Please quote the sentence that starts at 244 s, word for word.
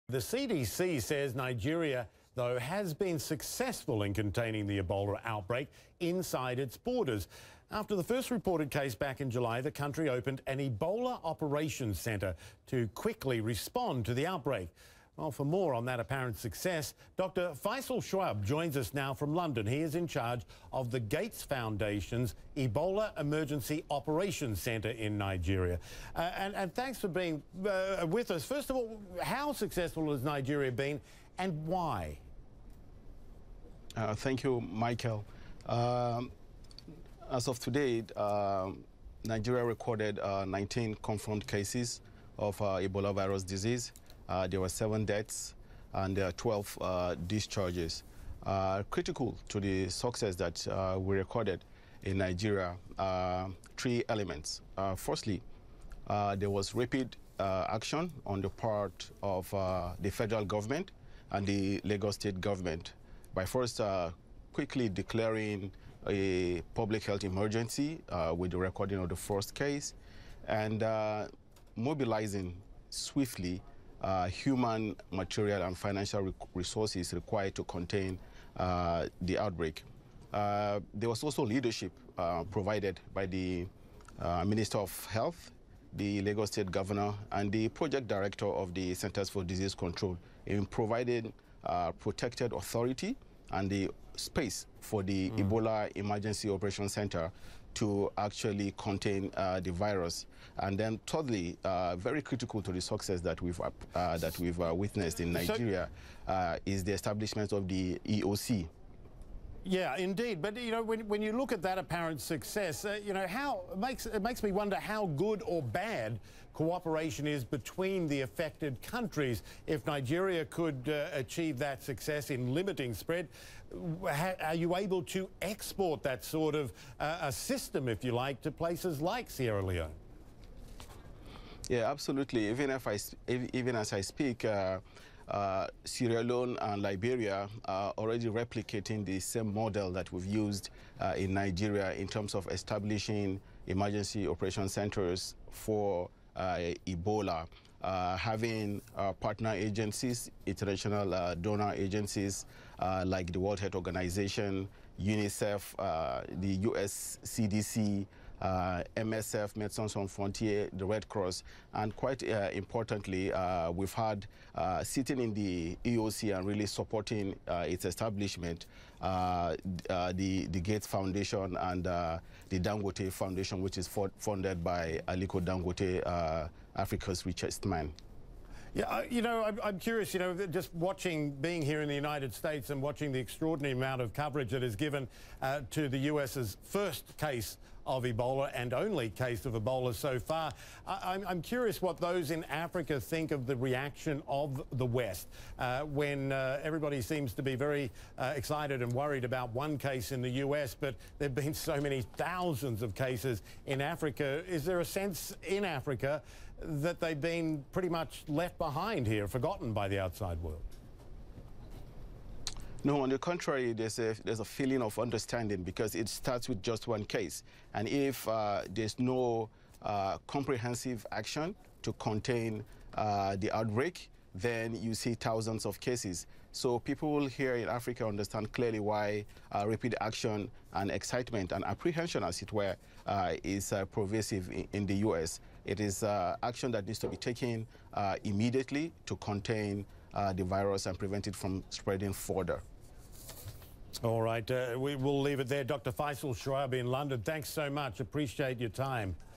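All right, uh, we will leave it there.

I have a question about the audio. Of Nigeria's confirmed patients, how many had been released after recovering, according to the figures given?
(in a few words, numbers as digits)
12.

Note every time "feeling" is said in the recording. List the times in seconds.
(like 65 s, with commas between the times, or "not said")
214 s.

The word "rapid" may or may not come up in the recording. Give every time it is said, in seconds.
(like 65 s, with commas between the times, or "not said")
56 s, 229 s.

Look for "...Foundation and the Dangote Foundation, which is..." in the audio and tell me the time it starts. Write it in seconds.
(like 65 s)
170 s.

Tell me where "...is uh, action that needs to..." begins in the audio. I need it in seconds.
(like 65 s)
235 s.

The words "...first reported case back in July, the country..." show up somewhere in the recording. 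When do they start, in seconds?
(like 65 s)
8 s.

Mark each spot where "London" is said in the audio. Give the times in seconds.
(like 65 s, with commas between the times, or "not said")
19 s, 246 s.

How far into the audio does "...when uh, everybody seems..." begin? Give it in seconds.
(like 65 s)
195 s.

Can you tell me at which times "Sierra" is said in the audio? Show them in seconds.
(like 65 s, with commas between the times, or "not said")
129 s, 135 s.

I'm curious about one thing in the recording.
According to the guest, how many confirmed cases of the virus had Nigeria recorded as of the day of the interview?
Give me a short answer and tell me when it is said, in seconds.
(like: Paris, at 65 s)
19, at 40 s.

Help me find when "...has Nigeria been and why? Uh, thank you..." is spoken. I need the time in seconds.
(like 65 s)
30 s.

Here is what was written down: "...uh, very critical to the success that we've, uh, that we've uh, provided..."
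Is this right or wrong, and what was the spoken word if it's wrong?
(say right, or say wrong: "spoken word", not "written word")
wrong: "witnessed", not "provided".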